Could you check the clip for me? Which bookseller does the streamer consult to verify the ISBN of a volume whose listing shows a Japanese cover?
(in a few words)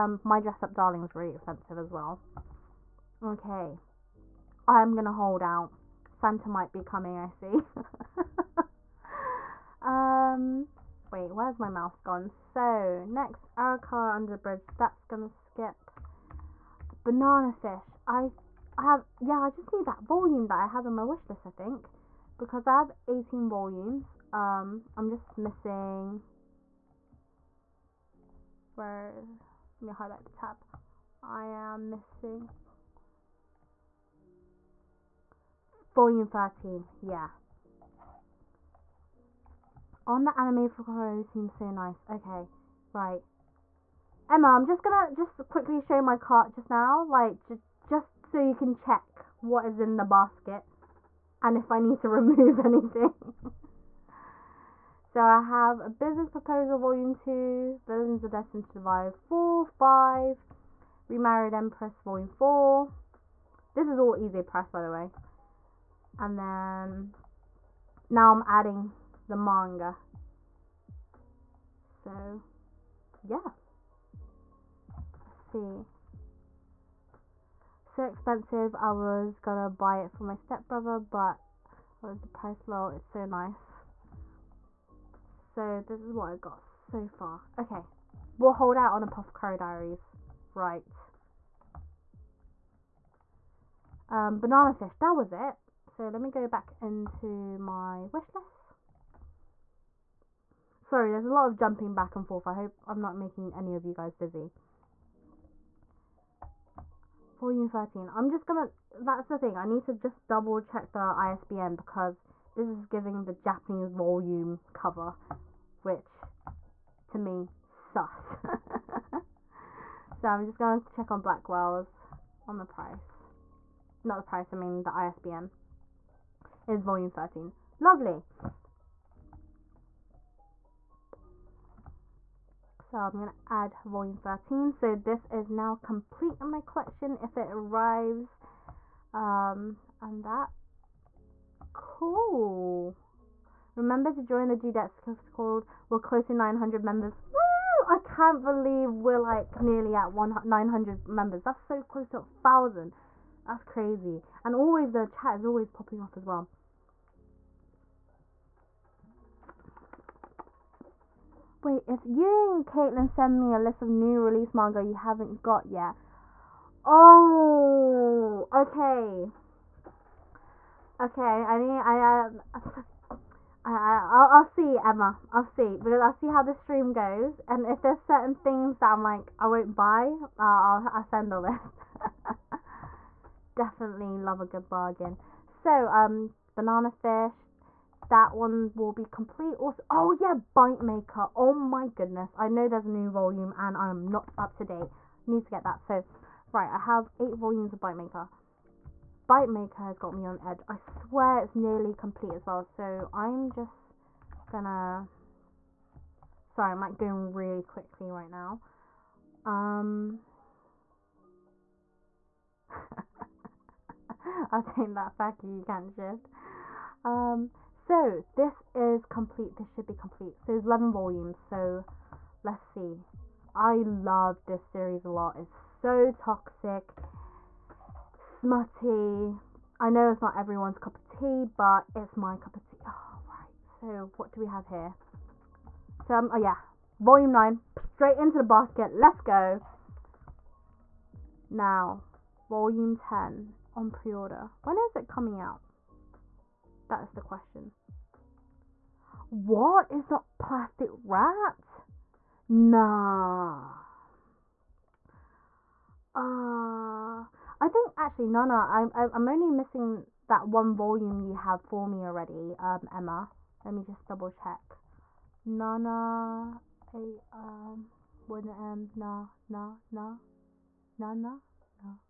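Blackwell's.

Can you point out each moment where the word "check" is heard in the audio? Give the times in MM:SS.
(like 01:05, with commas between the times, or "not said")
00:48, 01:50, 02:00, 04:24.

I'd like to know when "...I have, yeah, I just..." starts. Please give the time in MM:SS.
00:18.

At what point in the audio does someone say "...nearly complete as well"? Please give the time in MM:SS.
03:21.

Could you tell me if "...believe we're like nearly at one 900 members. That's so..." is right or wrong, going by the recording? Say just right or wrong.
right.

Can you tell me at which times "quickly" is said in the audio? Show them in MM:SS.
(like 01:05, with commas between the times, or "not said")
00:45, 03:27.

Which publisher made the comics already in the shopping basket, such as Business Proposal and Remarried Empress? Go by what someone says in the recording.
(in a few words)
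Ize Press.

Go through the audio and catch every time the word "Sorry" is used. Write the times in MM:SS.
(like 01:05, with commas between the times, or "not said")
01:40, 03:26.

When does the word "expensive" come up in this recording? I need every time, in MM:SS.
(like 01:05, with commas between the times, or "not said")
00:01, 01:18.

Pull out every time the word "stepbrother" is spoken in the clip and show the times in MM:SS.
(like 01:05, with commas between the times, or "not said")
01:20.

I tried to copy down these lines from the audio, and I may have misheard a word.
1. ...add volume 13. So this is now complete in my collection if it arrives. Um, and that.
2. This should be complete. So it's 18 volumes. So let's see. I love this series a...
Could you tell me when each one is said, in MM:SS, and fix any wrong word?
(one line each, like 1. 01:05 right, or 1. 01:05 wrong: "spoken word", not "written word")
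1. 02:13 right
2. 03:39 wrong: "11", not "18".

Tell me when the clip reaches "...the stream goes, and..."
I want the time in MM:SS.
02:56.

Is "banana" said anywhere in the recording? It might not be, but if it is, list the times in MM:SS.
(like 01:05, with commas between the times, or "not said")
00:17, 01:34, 03:06.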